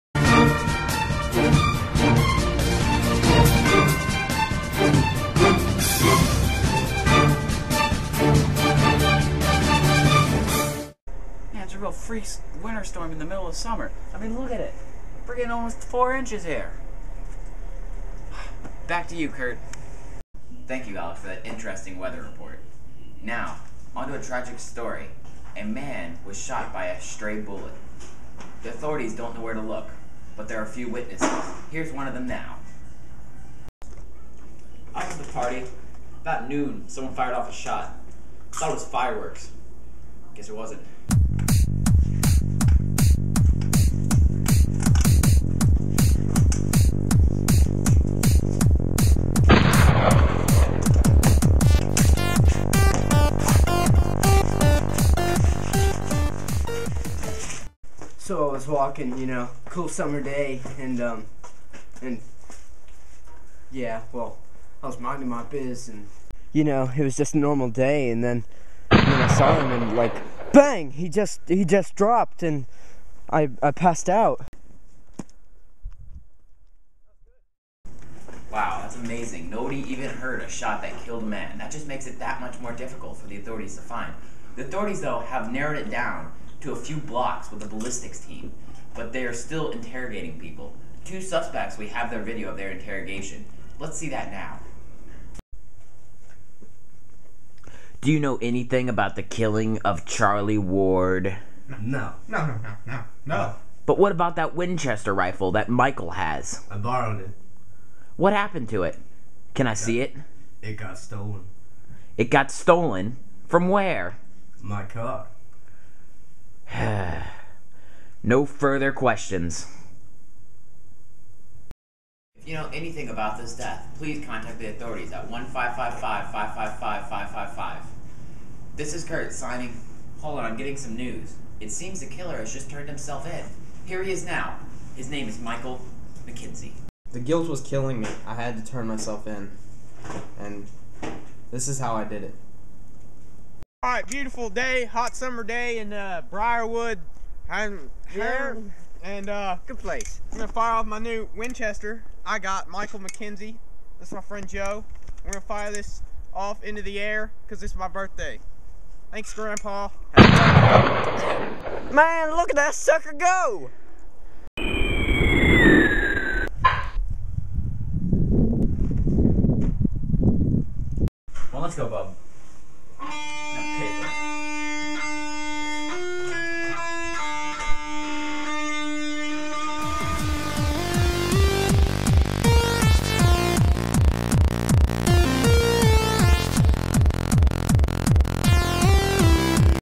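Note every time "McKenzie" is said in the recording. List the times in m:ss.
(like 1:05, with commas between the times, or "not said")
2:16, 2:32.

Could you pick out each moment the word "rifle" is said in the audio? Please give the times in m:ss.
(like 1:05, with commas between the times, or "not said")
1:45.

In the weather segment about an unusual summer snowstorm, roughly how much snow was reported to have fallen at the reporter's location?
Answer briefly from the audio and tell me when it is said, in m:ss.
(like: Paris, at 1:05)
almost 4 inches, at 0:15.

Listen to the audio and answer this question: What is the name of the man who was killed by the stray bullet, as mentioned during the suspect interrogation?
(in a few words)
Charlie Ward.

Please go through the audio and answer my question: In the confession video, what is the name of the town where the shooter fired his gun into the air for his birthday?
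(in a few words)
Briarwood.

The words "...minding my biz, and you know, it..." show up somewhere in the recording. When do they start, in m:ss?
1:05.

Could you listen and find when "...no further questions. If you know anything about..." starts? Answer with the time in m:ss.
1:58.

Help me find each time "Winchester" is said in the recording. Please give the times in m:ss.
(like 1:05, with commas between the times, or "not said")
1:44, 2:31.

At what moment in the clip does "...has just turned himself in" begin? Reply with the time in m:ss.
2:12.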